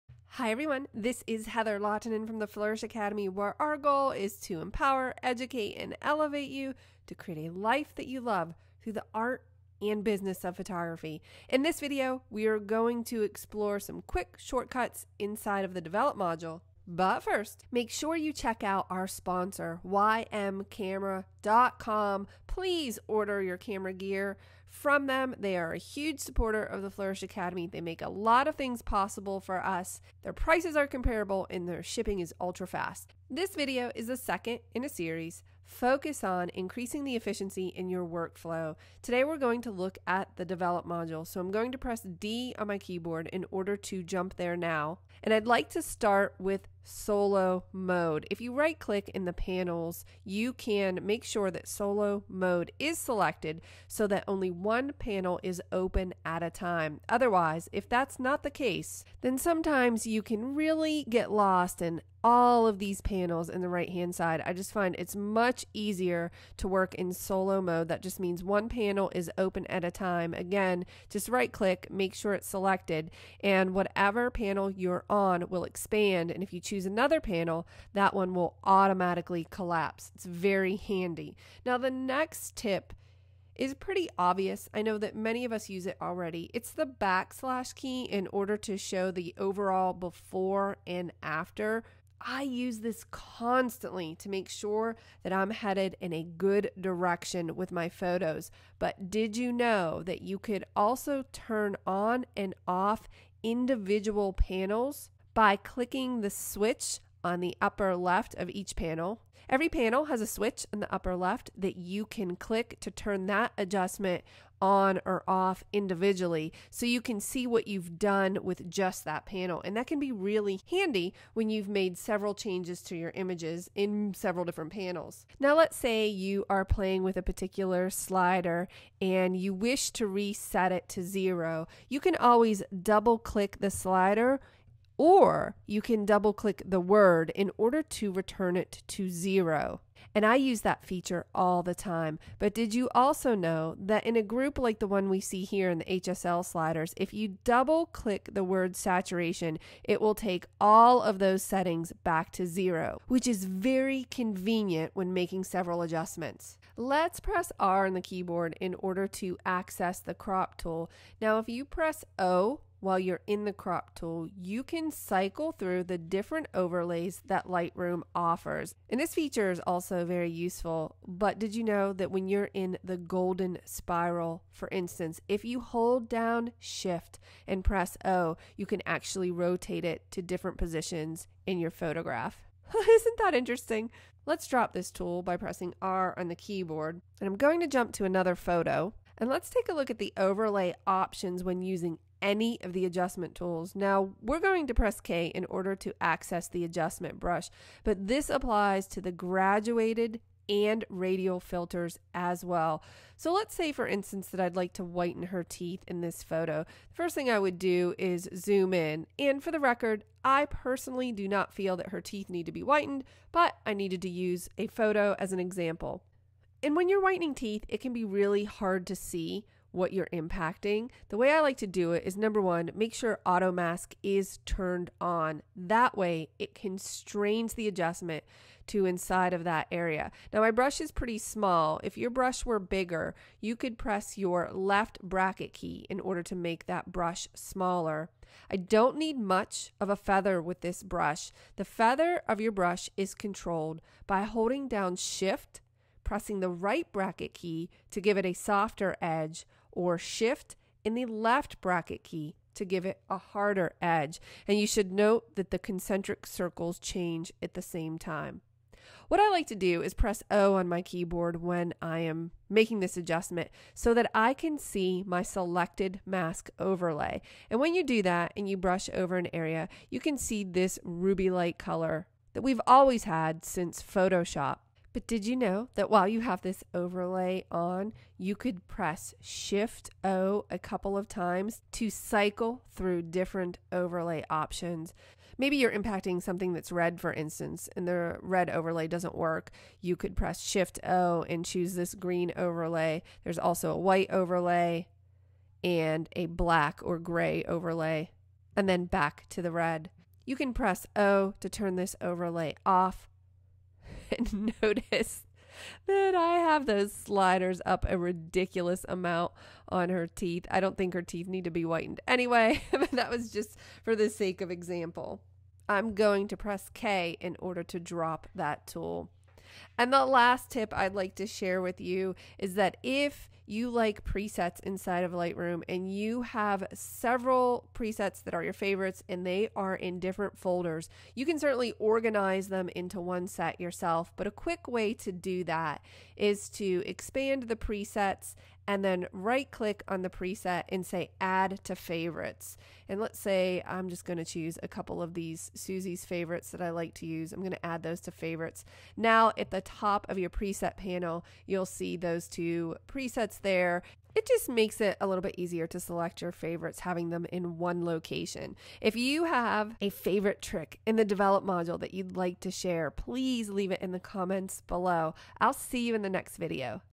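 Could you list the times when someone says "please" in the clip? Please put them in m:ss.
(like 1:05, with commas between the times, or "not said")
0:22, 6:02.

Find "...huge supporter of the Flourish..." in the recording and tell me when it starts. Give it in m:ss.
0:25.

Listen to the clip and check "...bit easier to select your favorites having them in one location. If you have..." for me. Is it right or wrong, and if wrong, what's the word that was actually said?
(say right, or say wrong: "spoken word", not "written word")
right.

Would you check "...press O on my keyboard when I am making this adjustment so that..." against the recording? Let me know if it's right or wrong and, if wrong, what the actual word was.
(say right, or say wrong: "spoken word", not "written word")
right.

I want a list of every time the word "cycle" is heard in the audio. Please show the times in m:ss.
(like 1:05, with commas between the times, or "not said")
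2:44, 4:41.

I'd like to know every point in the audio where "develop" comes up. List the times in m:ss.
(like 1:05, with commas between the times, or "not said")
0:15, 0:40, 6:01.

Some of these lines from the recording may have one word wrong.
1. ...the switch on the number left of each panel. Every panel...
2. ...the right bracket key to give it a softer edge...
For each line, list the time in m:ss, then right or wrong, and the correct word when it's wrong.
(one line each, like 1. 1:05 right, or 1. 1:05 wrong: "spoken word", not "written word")
1. 1:46 wrong: "upper", not "number"
2. 4:06 right.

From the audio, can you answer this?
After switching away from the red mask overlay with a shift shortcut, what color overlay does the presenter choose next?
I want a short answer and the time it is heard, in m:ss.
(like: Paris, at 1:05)
Green, at 4:51.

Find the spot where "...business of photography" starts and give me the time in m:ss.
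0:10.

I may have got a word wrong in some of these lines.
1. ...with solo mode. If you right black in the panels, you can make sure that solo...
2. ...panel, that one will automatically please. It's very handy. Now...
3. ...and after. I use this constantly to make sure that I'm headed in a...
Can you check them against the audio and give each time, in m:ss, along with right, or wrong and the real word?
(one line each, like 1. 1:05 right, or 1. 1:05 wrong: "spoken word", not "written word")
1. 0:46 wrong: "click", not "black"
2. 1:17 wrong: "collapse", not "please"
3. 1:30 right.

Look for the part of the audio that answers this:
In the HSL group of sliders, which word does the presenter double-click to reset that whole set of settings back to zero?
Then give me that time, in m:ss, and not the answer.
2:28.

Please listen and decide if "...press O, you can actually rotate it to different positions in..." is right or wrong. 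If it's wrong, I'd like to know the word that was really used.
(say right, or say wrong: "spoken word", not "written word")
right.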